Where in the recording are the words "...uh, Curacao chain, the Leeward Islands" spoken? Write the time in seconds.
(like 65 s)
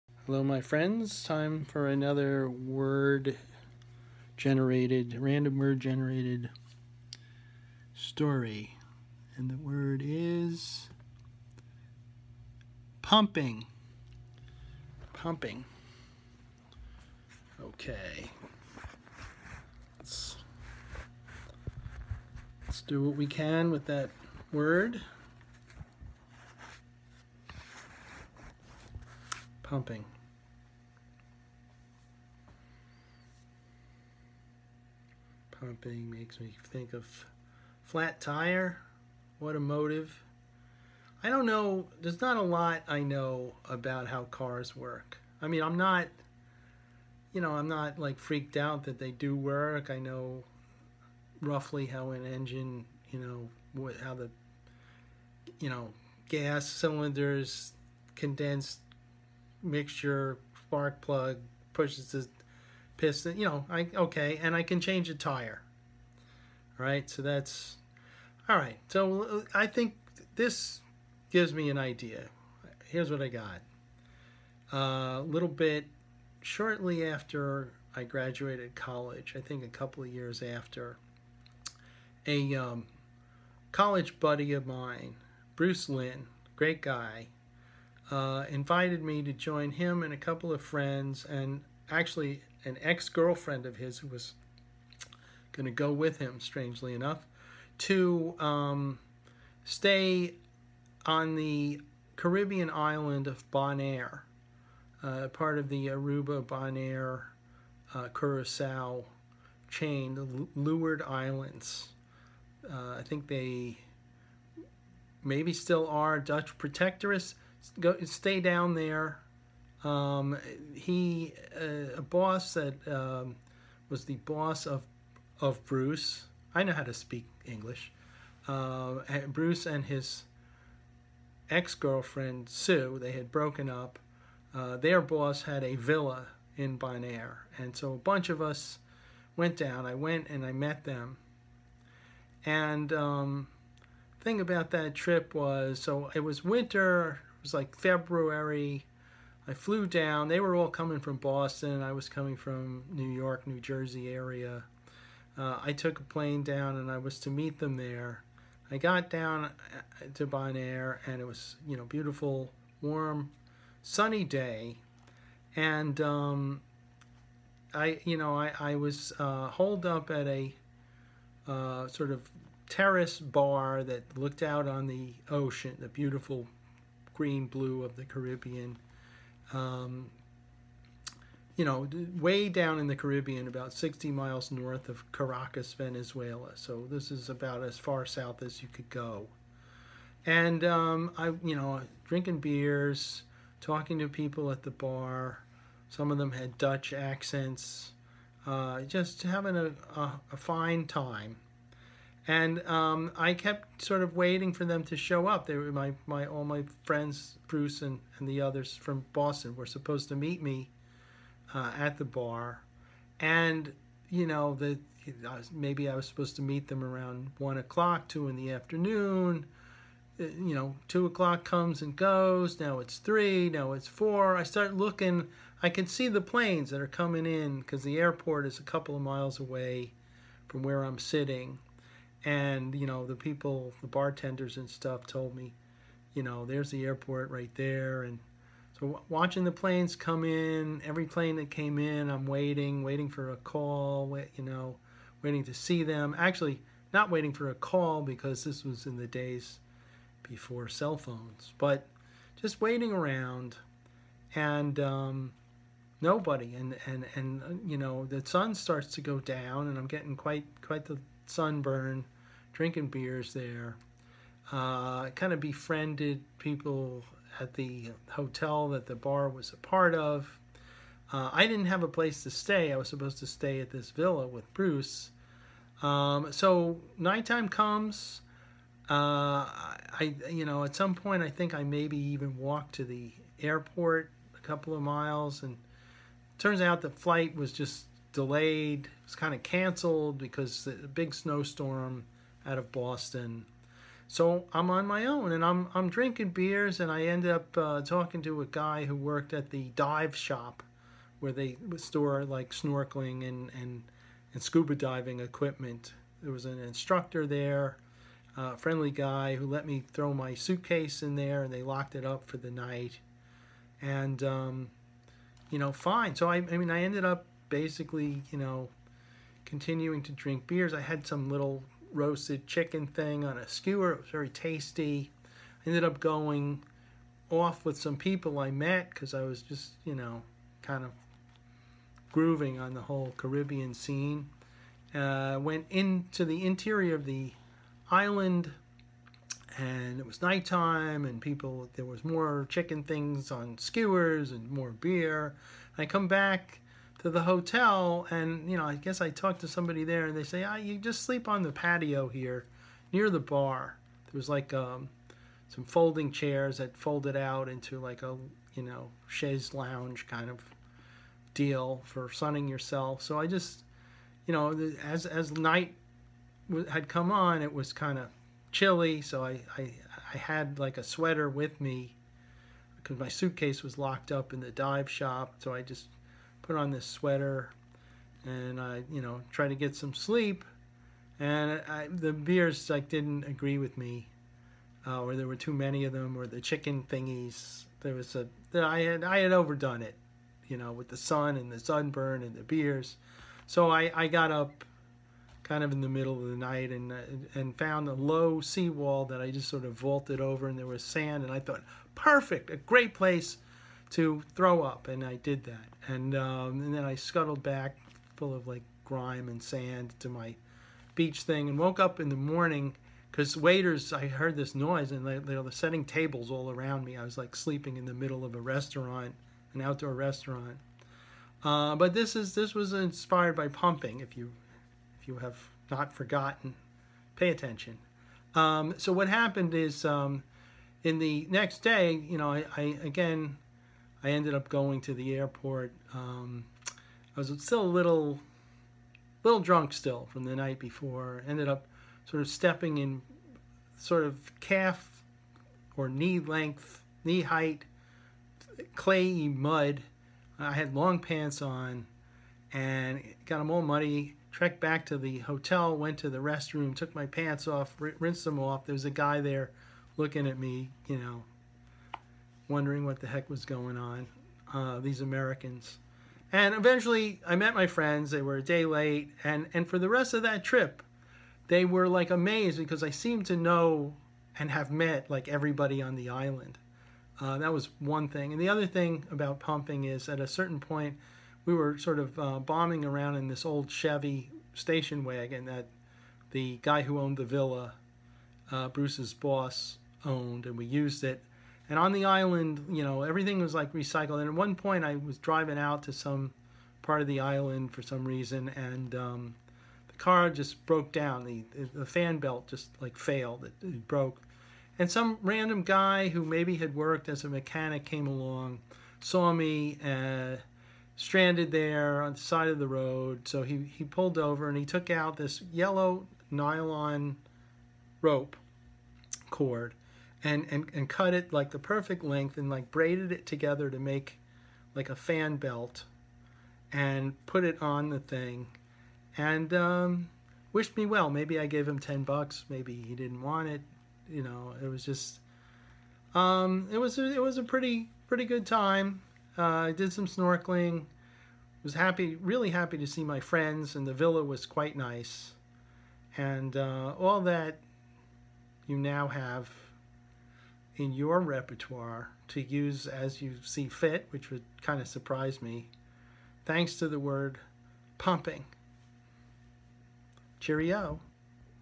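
107 s.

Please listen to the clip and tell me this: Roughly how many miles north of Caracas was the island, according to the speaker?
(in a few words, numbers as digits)
60 miles.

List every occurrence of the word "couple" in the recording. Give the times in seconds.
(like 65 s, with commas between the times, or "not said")
79 s, 90 s, 228 s, 284 s.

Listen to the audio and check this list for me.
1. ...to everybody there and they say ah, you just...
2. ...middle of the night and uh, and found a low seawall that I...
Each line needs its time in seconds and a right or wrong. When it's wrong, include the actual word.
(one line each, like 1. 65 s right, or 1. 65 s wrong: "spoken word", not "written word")
1. 349 s wrong: "somebody", not "everybody"
2. 395 s right.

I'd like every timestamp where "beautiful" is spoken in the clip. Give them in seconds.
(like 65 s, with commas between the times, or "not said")
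161 s, 175 s.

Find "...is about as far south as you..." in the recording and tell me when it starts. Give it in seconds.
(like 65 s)
187 s.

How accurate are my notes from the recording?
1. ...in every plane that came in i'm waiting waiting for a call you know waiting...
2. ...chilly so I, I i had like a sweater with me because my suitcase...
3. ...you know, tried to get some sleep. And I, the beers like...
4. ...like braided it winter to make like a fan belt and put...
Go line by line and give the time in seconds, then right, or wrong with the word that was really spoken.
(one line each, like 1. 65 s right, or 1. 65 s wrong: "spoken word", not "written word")
1. 240 s right
2. 368 s right
3. 378 s right
4. 522 s wrong: "together", not "winter".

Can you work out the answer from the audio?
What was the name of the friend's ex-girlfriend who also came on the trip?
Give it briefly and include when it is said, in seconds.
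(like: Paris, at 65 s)
Sue, at 132 s.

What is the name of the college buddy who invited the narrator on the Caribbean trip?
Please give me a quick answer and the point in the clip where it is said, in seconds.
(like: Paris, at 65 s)
Bruce Lynn, at 85 s.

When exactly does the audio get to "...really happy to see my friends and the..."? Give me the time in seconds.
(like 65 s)
542 s.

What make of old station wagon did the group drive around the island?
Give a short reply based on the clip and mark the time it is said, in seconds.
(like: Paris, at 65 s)
Chevy, at 483 s.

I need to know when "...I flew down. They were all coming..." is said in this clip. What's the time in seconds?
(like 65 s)
149 s.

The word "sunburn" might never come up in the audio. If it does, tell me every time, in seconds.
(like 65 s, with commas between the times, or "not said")
261 s, 391 s.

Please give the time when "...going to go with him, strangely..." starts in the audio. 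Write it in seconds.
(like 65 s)
95 s.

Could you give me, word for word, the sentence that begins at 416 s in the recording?
I was like sleeping in the middle of a restaurant, an outdoor restaurant.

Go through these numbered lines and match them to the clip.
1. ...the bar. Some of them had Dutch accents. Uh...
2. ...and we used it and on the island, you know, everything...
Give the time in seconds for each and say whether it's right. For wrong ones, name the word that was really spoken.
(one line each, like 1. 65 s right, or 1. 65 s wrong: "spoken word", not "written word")
1. 194 s right
2. 490 s right.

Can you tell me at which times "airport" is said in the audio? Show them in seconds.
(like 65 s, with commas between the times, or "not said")
227 s, 236 s, 283 s, 435 s.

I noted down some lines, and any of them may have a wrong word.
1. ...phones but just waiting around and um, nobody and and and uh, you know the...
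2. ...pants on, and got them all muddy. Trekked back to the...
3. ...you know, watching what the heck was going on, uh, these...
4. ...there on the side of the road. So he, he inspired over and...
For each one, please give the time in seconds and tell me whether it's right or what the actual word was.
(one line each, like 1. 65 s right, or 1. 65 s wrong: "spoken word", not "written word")
1. 250 s right
2. 450 s right
3. 460 s wrong: "wondering", not "watching"
4. 511 s wrong: "pulled", not "inspired".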